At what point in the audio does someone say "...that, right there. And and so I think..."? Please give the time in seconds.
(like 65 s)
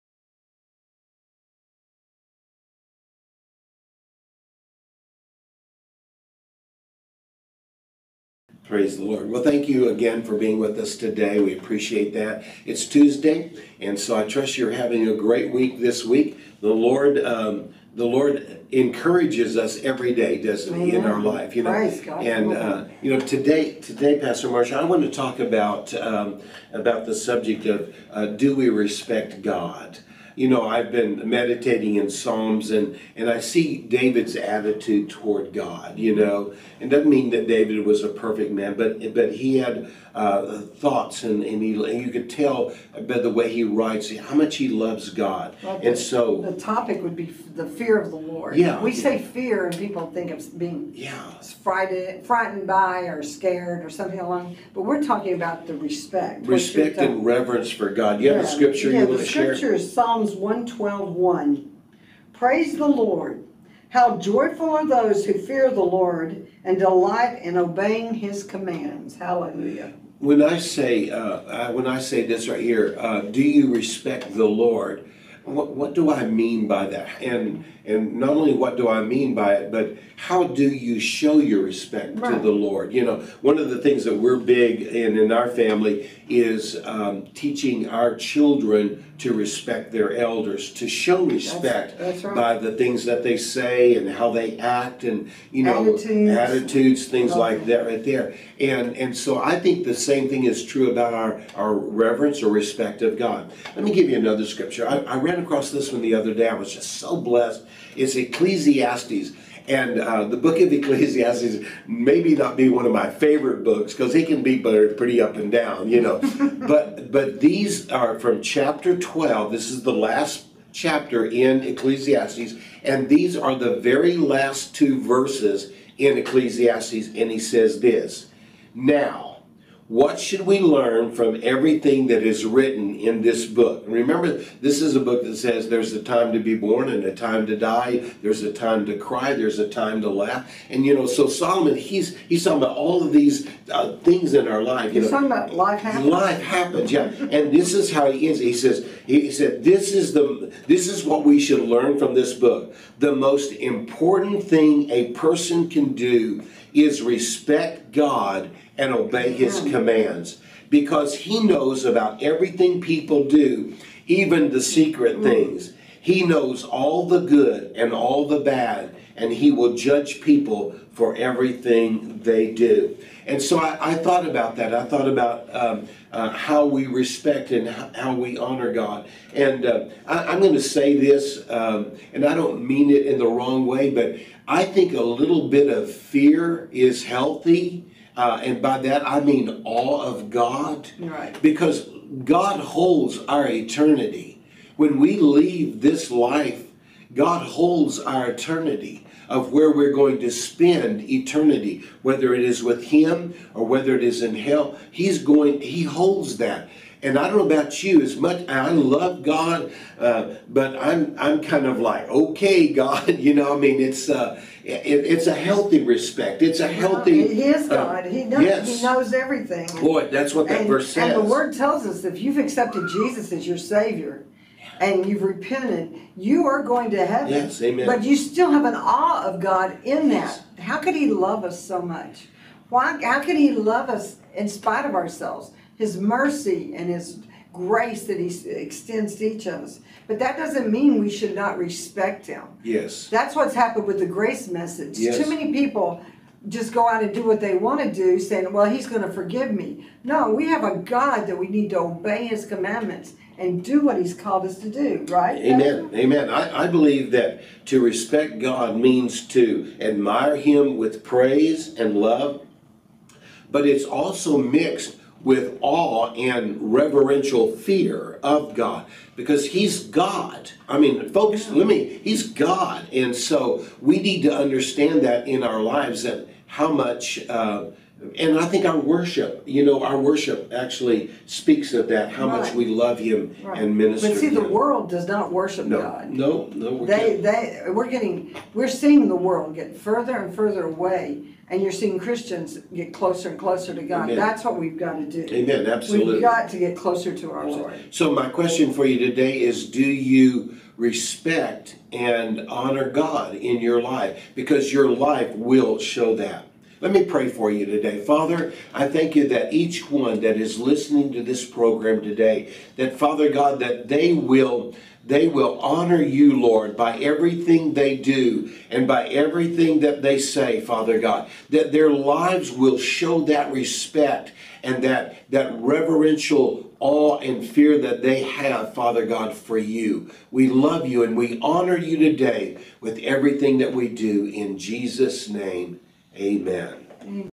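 97 s.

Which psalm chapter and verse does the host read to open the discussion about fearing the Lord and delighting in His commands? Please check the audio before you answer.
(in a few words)
Psalms 112:1.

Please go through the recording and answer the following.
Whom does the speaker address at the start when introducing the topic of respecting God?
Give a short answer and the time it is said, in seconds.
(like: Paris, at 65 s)
Pastor Marshall, at 24 s.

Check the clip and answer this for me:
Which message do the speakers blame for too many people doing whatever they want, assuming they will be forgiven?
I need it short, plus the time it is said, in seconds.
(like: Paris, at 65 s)
the grace message, at 243 s.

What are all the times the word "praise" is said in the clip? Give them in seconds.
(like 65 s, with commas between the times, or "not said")
8 s, 62 s, 261 s.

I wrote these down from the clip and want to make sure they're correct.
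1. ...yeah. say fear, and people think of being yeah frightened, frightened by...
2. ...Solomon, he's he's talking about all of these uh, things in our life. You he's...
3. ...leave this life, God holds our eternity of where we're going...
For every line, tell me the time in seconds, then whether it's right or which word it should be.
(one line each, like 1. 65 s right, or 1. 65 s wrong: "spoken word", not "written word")
1. 48 s right
2. 141 s right
3. 195 s right.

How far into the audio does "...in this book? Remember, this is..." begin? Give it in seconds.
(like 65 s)
132 s.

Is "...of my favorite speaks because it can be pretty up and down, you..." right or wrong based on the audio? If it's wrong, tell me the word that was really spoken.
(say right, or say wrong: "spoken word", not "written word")
wrong: "books", not "speaks".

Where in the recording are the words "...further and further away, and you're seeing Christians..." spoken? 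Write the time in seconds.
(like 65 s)
289 s.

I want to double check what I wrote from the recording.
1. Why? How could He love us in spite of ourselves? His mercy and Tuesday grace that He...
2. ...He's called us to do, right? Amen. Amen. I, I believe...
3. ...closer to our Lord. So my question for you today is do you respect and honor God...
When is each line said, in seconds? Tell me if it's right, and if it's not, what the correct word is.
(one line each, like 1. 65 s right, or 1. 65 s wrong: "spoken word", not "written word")
1. 232 s wrong: "His", not "Tuesday"
2. 253 s right
3. 296 s right.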